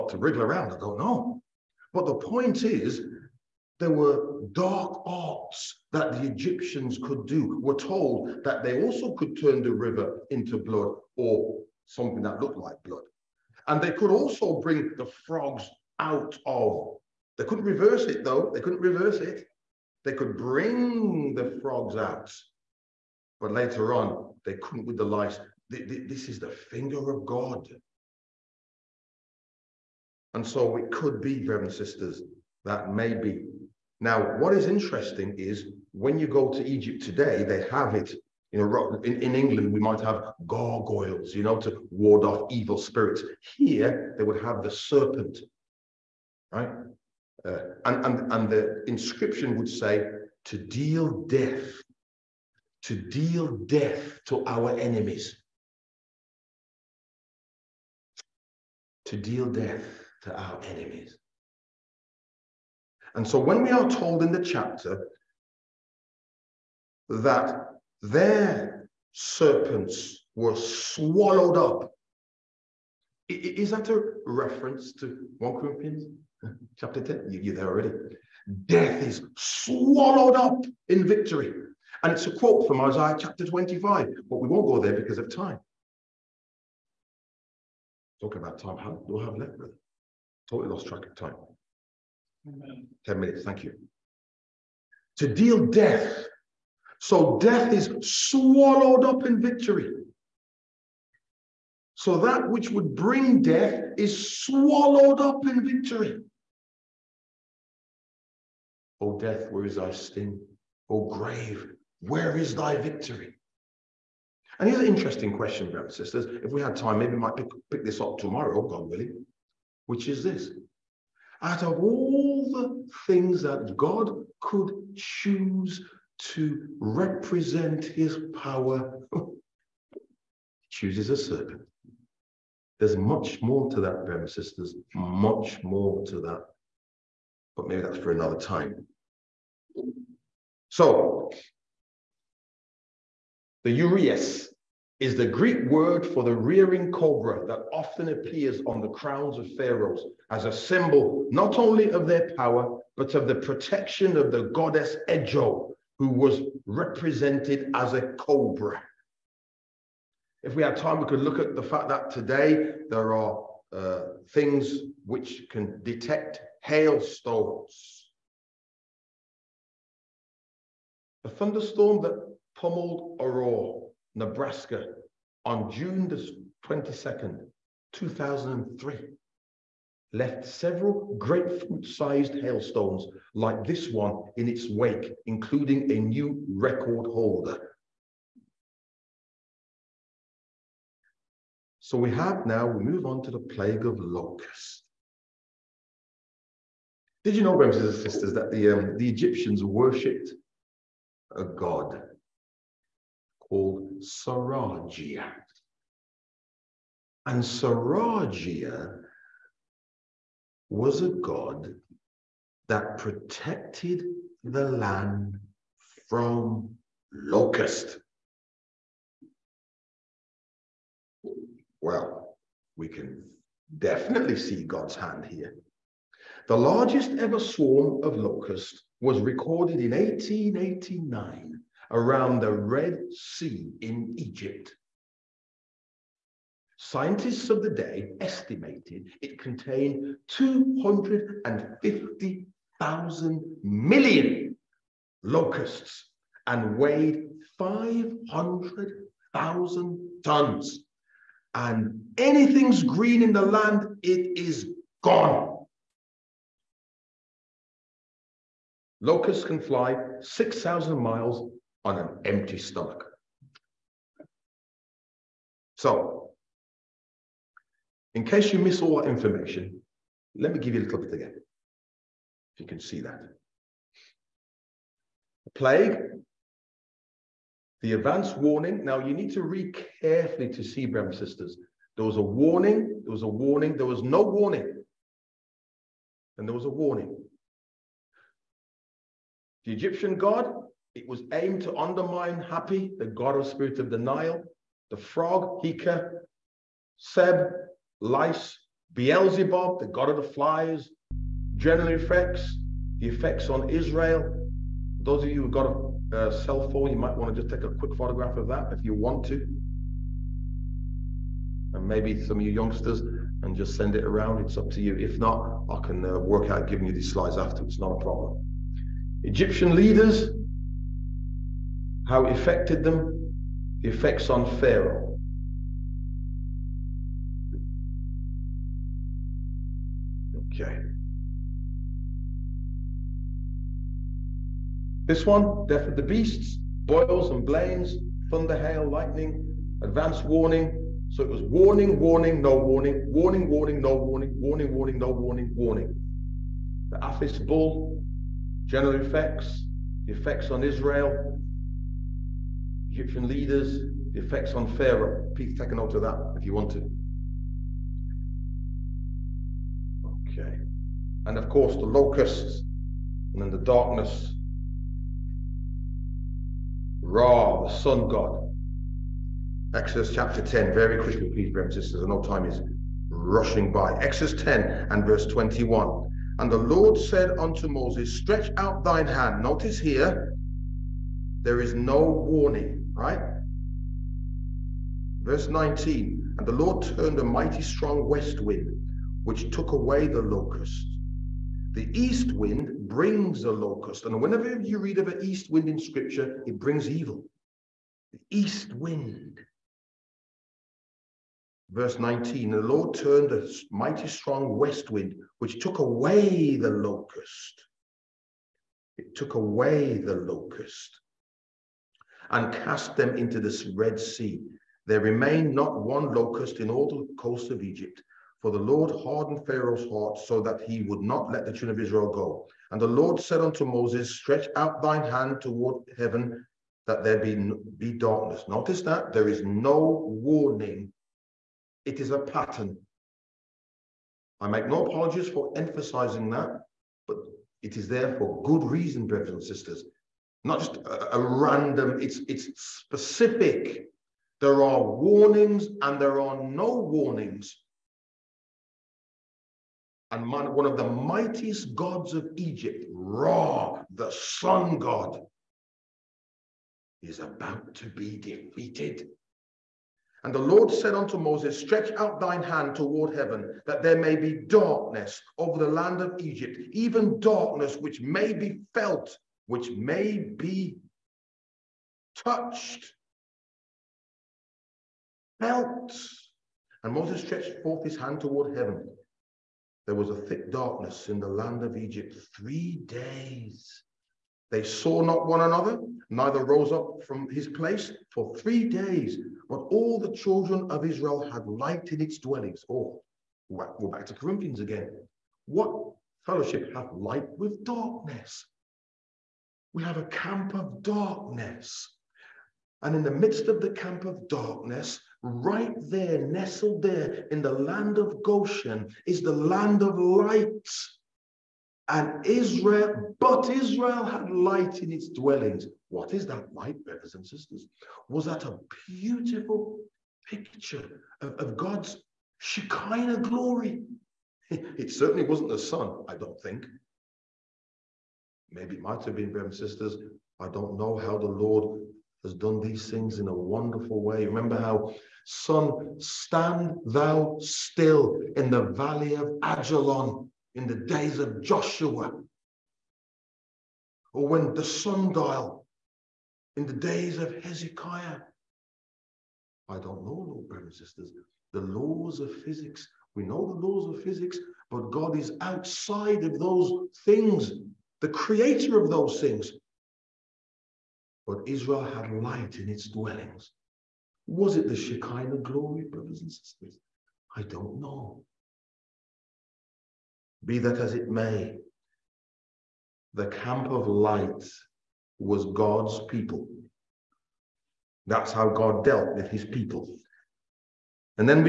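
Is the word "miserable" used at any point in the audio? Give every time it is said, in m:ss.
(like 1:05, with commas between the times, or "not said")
not said.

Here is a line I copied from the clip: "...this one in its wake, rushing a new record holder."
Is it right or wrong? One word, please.
wrong.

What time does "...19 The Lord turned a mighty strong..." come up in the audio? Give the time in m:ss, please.
6:41.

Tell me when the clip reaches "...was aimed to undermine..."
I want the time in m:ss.
4:51.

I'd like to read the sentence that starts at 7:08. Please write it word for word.
Notice that there is no warning, it is a pattern.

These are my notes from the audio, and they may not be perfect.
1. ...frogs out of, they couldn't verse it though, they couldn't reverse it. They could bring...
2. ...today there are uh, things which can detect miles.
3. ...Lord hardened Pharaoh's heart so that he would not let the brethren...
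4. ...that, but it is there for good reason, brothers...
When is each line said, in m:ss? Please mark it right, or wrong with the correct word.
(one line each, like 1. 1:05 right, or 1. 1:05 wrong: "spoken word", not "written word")
1. 0:15 wrong: "reverse", not "verse"
2. 2:42 wrong: "hailstones", not "miles"
3. 6:58 wrong: "children", not "brethren"
4. 7:16 right.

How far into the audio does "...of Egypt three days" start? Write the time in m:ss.
8:01.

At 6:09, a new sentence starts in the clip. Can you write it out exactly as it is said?
Exodus chapter 10, very quickly, please, brothers and sisters, I know time is rushing by.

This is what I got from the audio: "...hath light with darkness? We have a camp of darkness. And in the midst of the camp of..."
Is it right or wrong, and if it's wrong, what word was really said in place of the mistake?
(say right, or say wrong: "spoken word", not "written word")
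right.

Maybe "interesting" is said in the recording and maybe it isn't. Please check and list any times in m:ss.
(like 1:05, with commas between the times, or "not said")
0:34, 1:54.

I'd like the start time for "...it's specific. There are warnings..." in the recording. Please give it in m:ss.
7:22.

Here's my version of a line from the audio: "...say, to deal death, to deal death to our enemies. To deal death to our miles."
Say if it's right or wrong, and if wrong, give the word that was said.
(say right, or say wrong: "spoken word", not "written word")
wrong: "enemies", not "miles".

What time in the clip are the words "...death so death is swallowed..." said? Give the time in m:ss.
1:35.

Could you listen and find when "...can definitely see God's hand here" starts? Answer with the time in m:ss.
3:42.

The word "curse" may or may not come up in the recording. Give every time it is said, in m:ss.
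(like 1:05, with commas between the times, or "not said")
not said.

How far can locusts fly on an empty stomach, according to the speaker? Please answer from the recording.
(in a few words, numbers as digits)
6,000 miles.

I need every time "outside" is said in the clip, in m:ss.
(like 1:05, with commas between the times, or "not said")
9:15.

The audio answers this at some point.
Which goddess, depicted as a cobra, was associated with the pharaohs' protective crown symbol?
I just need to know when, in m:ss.
2:35.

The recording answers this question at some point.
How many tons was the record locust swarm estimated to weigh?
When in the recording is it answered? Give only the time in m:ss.
4:07.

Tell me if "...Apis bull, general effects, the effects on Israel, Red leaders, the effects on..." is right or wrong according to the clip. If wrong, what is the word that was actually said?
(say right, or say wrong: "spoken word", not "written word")
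wrong: "Egyptian", not "Red".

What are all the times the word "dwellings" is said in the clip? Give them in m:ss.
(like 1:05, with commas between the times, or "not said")
8:12, 8:35, 9:22.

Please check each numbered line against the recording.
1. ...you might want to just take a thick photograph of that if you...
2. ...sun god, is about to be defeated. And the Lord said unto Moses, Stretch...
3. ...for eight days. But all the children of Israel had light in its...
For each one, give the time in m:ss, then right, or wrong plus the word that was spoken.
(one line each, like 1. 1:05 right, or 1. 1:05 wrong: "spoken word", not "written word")
1. 5:06 wrong: "quick", not "thick"
2. 7:34 right
3. 8:08 wrong: "three", not "eight".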